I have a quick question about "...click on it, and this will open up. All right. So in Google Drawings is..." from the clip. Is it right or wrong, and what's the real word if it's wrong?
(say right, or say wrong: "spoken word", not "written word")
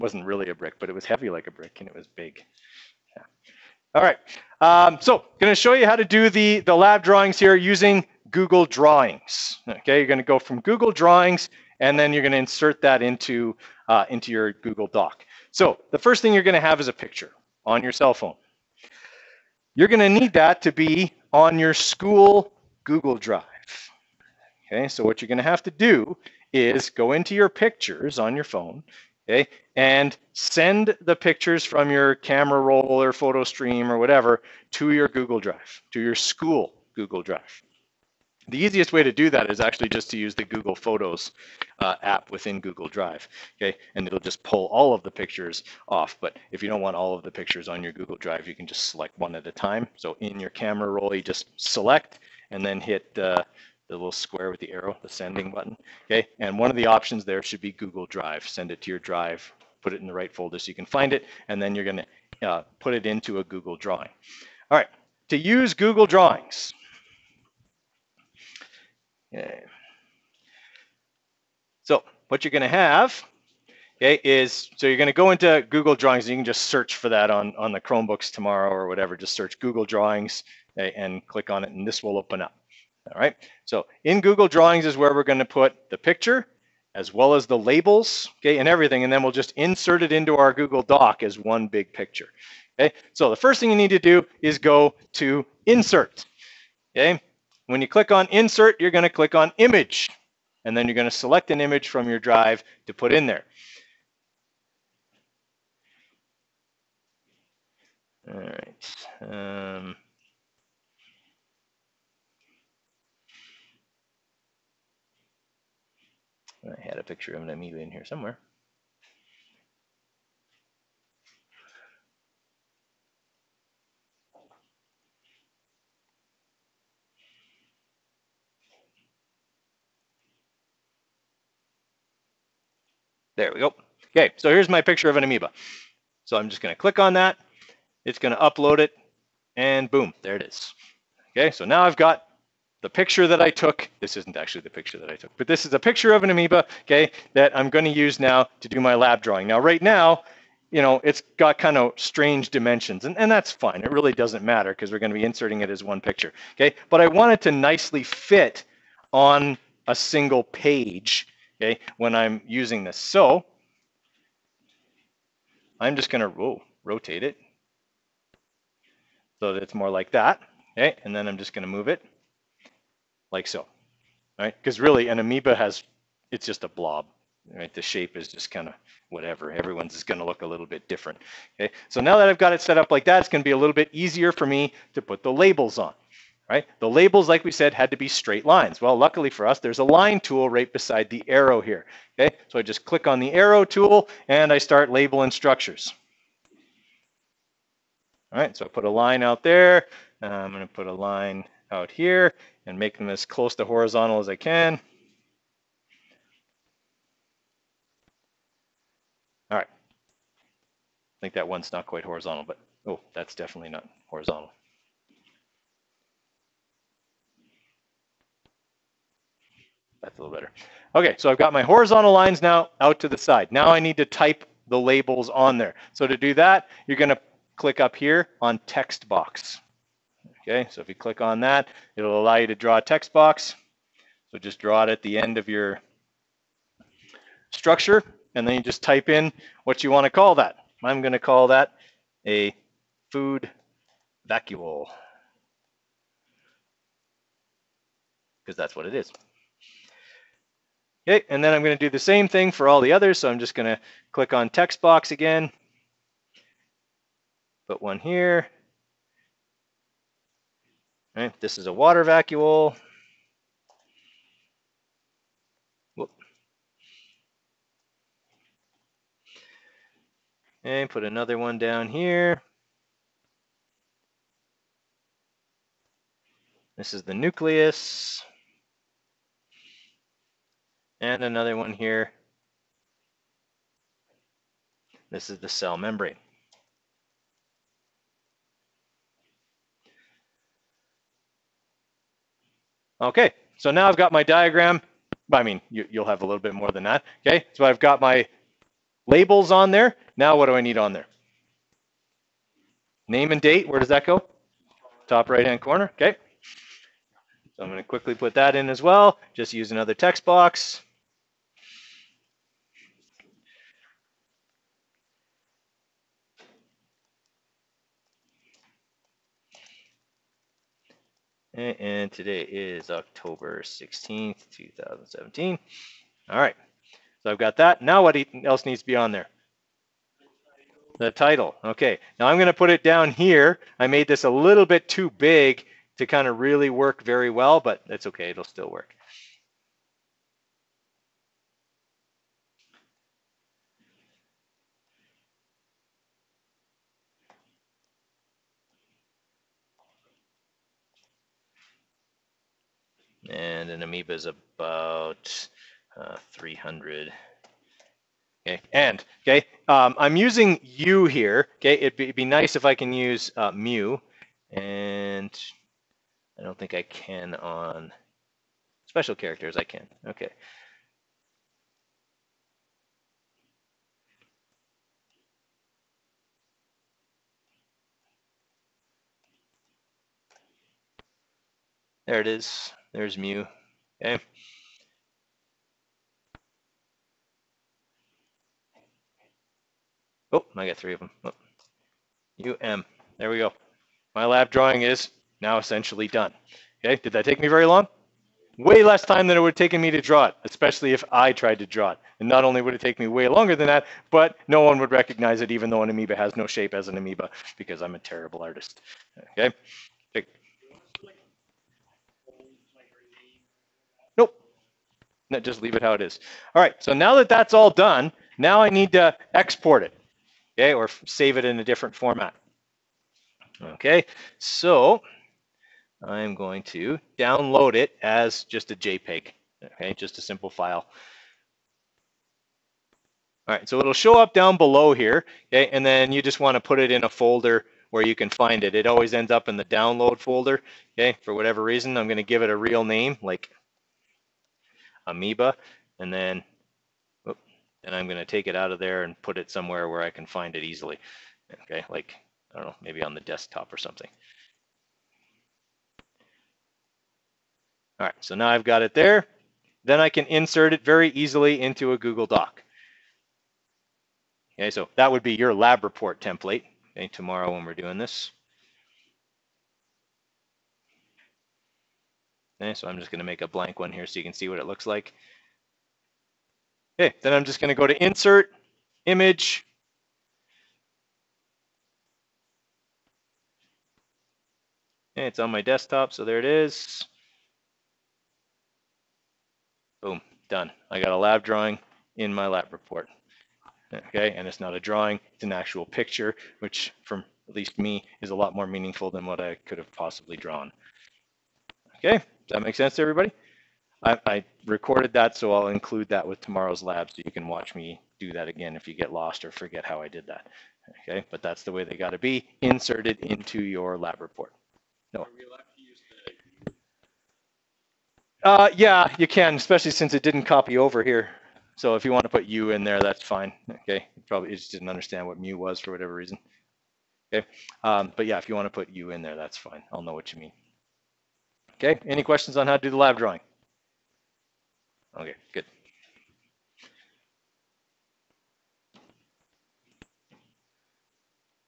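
right.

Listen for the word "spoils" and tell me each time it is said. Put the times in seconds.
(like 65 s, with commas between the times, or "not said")
not said.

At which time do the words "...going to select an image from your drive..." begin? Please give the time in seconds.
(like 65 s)
100 s.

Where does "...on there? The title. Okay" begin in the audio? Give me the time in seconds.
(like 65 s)
328 s.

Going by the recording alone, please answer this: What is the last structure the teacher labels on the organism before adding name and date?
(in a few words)
Cell membrane.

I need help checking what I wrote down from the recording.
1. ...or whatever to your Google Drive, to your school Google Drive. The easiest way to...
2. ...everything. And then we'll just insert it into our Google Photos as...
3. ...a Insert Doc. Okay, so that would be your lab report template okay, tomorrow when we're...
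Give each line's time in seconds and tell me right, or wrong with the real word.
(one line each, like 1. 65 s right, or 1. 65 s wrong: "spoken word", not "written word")
1. 33 s right
2. 88 s wrong: "Doc", not "Photos"
3. 461 s wrong: "Google", not "Insert".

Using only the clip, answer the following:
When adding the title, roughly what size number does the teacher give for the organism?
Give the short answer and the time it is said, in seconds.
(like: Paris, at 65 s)
300, at 356 s.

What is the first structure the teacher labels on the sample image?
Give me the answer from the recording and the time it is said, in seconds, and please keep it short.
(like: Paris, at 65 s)
Food vacuole, at 243 s.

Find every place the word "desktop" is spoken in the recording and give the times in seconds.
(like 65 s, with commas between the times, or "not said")
453 s, 485 s.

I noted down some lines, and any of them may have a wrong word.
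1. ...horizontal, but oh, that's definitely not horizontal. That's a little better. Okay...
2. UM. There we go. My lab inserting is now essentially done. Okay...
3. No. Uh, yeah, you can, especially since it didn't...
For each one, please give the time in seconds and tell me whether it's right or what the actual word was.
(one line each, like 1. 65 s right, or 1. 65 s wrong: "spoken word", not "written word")
1. 212 s right
2. 392 s wrong: "drawing", not "inserting"
3. 515 s right.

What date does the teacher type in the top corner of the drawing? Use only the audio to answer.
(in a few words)
October 16, 2017.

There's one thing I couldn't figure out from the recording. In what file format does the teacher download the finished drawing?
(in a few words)
JPEG.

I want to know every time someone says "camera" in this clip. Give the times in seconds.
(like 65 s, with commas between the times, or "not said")
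32 s, 50 s.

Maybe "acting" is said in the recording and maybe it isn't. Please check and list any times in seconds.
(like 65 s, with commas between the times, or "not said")
not said.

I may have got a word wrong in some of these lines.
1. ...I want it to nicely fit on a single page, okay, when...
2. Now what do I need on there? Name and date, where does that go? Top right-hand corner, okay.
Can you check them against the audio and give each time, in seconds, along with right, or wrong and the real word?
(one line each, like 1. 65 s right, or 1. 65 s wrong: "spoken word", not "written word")
1. 157 s right
2. 300 s right.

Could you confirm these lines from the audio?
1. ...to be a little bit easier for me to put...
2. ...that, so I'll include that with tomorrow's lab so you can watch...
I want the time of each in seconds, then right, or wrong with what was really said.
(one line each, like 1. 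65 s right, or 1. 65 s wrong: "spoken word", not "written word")
1. 183 s right
2. 505 s right.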